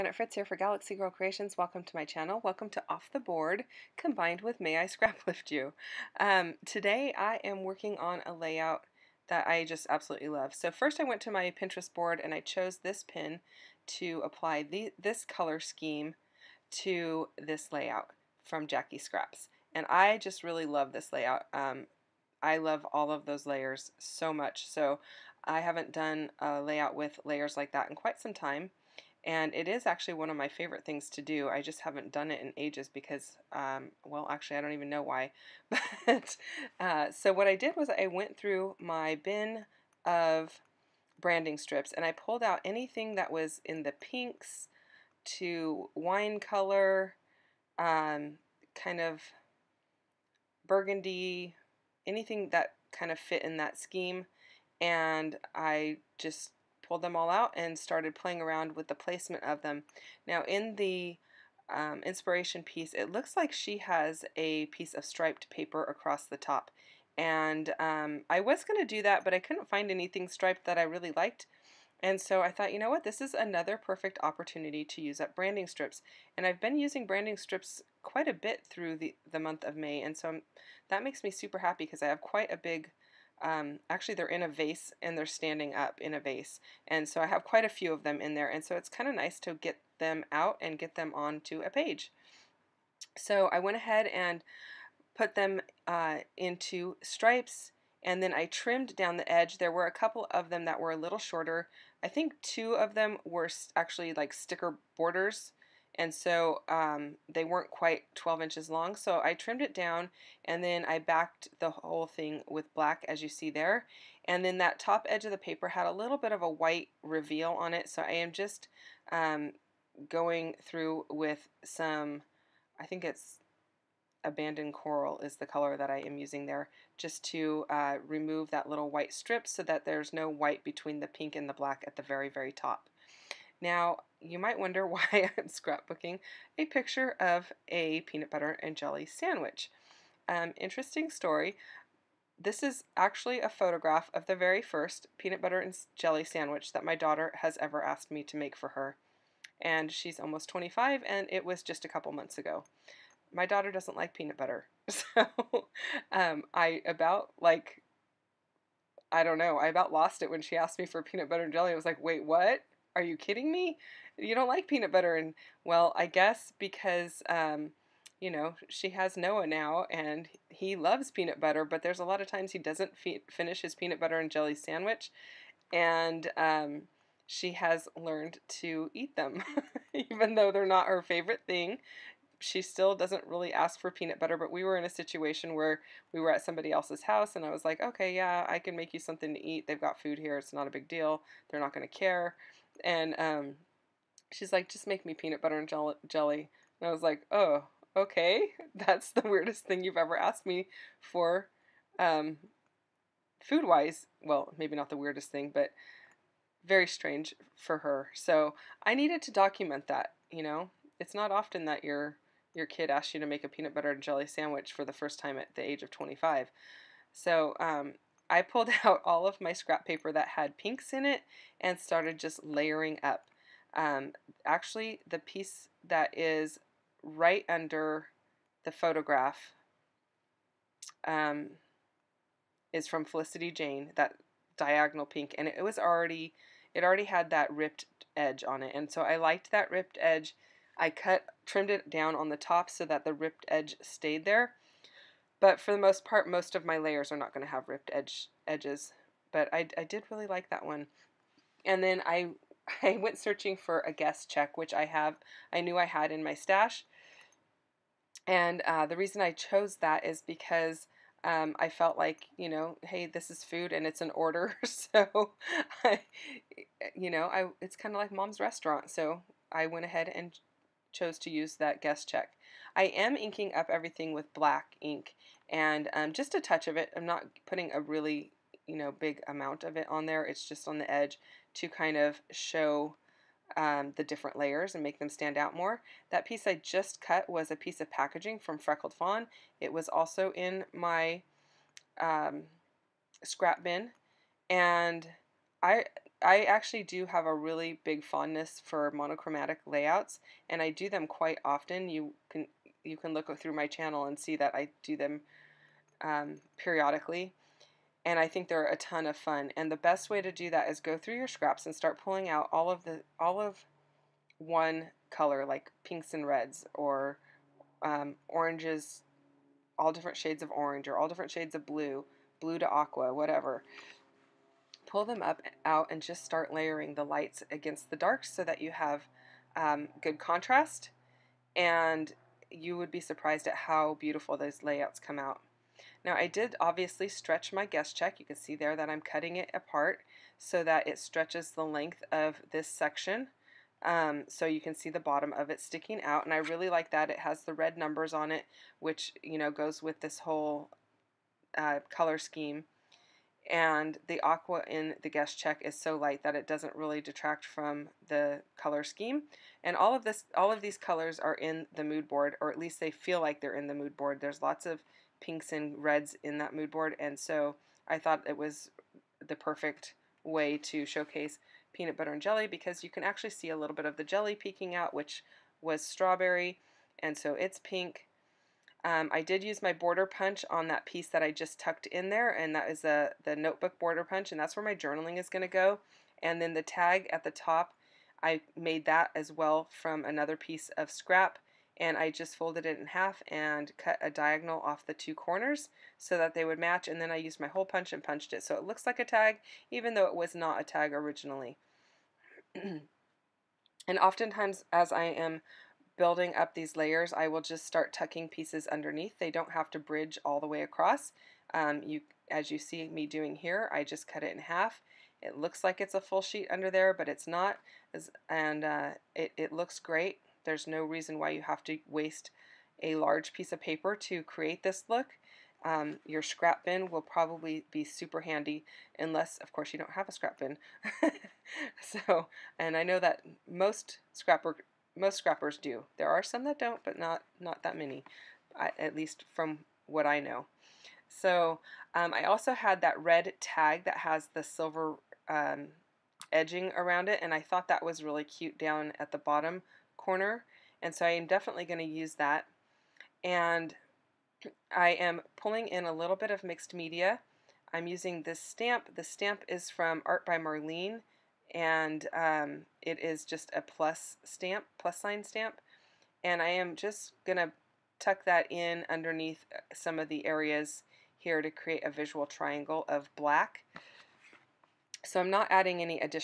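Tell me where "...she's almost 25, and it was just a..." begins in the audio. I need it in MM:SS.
02:29.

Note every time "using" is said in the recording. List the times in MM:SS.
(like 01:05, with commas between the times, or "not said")
01:16, 02:06, 07:37.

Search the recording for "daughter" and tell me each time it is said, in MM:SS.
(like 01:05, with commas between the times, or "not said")
02:26, 02:33.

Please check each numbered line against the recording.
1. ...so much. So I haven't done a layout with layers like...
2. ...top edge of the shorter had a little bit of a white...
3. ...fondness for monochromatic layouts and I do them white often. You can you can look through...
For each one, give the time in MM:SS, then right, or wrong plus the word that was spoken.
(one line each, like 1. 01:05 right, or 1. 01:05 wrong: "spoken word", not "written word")
1. 00:23 right
2. 01:54 wrong: "paper", not "shorter"
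3. 04:58 wrong: "quite", not "white".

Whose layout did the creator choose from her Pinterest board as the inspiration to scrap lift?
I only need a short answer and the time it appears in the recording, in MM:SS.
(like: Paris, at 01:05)
Jackie Scraps, at 00:18.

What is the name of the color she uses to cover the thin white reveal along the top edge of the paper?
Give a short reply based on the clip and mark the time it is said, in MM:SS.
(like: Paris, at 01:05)
Abandoned coral, at 02:04.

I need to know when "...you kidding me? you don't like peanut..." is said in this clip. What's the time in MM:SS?
02:43.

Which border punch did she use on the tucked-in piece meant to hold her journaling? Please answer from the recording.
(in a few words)
Notebook border punch.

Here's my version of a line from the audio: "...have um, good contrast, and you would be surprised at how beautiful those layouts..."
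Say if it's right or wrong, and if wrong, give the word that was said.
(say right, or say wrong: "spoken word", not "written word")
right.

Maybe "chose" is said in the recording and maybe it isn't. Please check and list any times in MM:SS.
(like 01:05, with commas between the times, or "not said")
00:12, 04:19, 04:30.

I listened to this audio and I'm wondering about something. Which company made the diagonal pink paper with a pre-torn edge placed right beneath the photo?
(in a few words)
Felicity Jane.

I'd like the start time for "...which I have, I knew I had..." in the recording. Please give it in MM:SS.
04:14.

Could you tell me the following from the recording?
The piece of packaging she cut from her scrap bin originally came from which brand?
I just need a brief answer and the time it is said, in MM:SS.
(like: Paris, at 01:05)
Freckled Fawn, at 04:48.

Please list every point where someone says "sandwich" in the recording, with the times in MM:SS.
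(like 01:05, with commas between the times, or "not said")
02:19, 02:26, 02:54, 03:34.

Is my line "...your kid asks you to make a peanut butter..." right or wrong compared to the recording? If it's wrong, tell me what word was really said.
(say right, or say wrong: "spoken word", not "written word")
right.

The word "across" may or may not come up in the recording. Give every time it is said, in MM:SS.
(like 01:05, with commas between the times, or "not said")
01:05, 06:50.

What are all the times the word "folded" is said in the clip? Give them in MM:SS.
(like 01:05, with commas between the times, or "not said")
06:32.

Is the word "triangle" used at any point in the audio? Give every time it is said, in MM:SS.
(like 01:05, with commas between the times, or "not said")
07:52.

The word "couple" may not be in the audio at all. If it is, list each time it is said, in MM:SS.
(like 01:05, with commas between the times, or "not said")
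01:39, 02:31.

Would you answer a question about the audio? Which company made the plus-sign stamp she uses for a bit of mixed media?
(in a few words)
Art by Marlene.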